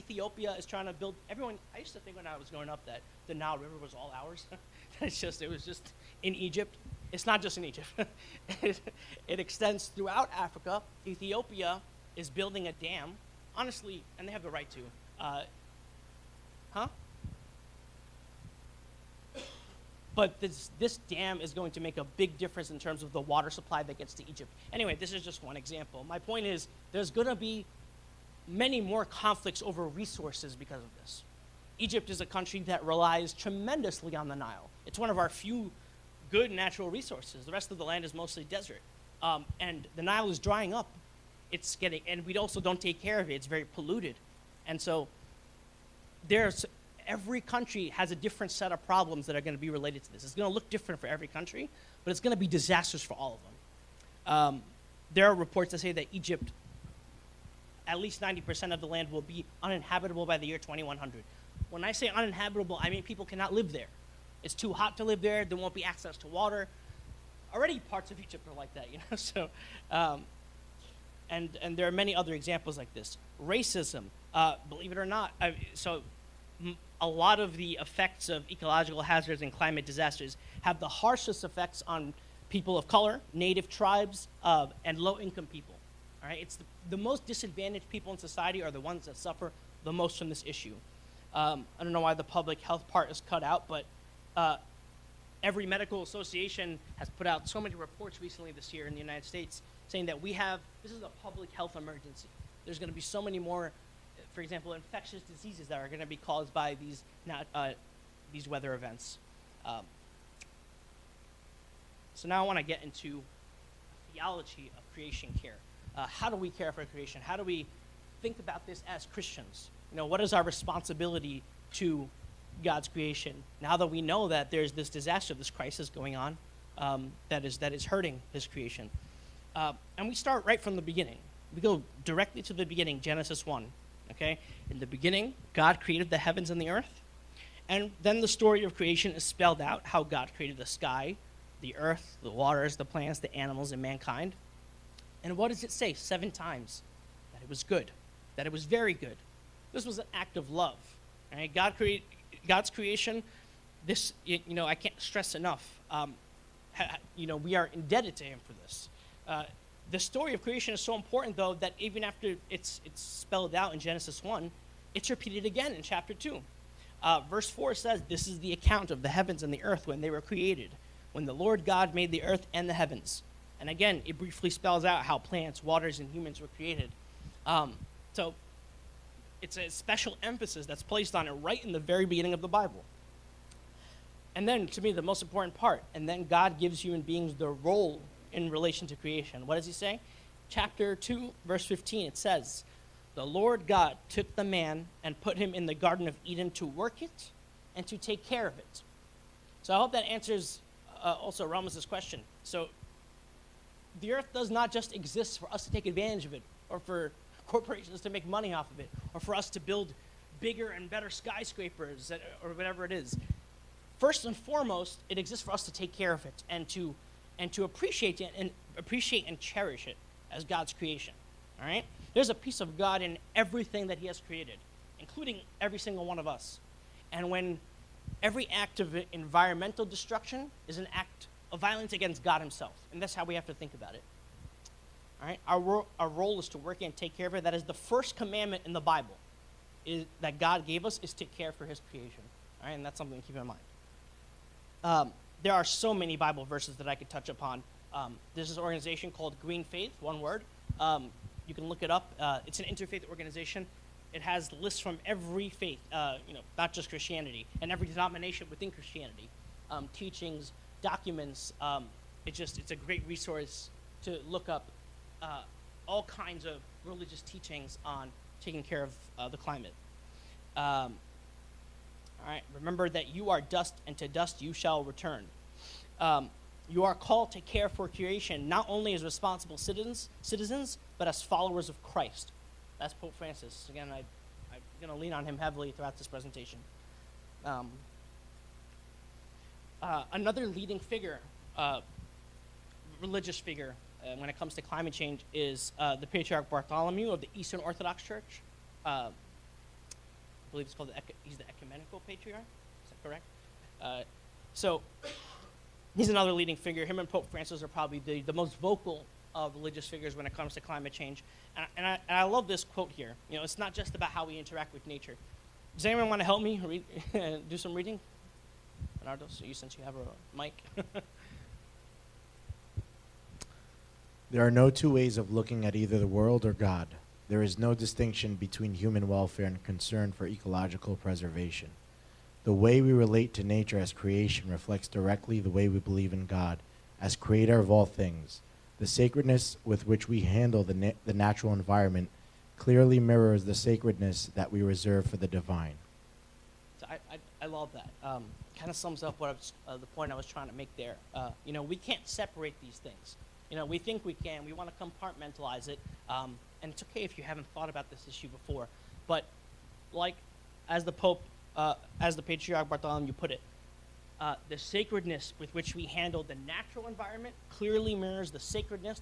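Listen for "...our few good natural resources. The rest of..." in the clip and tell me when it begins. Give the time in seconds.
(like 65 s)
35 s.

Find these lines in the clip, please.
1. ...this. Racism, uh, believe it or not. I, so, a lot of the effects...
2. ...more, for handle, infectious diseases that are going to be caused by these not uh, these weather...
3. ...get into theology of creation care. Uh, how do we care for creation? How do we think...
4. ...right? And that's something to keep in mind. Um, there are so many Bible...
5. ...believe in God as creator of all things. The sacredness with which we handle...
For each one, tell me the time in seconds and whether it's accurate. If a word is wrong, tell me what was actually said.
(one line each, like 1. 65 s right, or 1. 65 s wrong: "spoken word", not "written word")
1. 72 s right
2. 103 s wrong: "example", not "handle"
3. 112 s right
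4. 242 s right
5. 335 s right.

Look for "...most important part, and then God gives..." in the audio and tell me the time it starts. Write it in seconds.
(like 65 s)
185 s.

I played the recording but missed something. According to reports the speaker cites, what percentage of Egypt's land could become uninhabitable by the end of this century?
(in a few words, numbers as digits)
90%.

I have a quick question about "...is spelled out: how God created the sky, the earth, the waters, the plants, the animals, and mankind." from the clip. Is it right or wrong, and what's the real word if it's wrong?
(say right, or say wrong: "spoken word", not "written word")
right.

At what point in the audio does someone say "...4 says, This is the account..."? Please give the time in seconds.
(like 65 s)
167 s.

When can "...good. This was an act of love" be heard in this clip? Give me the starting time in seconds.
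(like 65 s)
148 s.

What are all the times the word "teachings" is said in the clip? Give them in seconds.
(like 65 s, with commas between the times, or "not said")
259 s, 267 s.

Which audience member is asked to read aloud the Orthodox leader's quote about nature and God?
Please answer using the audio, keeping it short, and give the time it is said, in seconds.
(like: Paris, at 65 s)
Bernardo, at 318 s.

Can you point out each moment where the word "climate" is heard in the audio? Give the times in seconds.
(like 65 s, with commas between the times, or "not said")
79 s, 269 s, 294 s, 310 s.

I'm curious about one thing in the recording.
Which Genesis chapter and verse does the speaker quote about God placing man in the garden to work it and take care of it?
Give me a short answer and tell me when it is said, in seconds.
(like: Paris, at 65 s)
Chapter 2, verse 15, at 190 s.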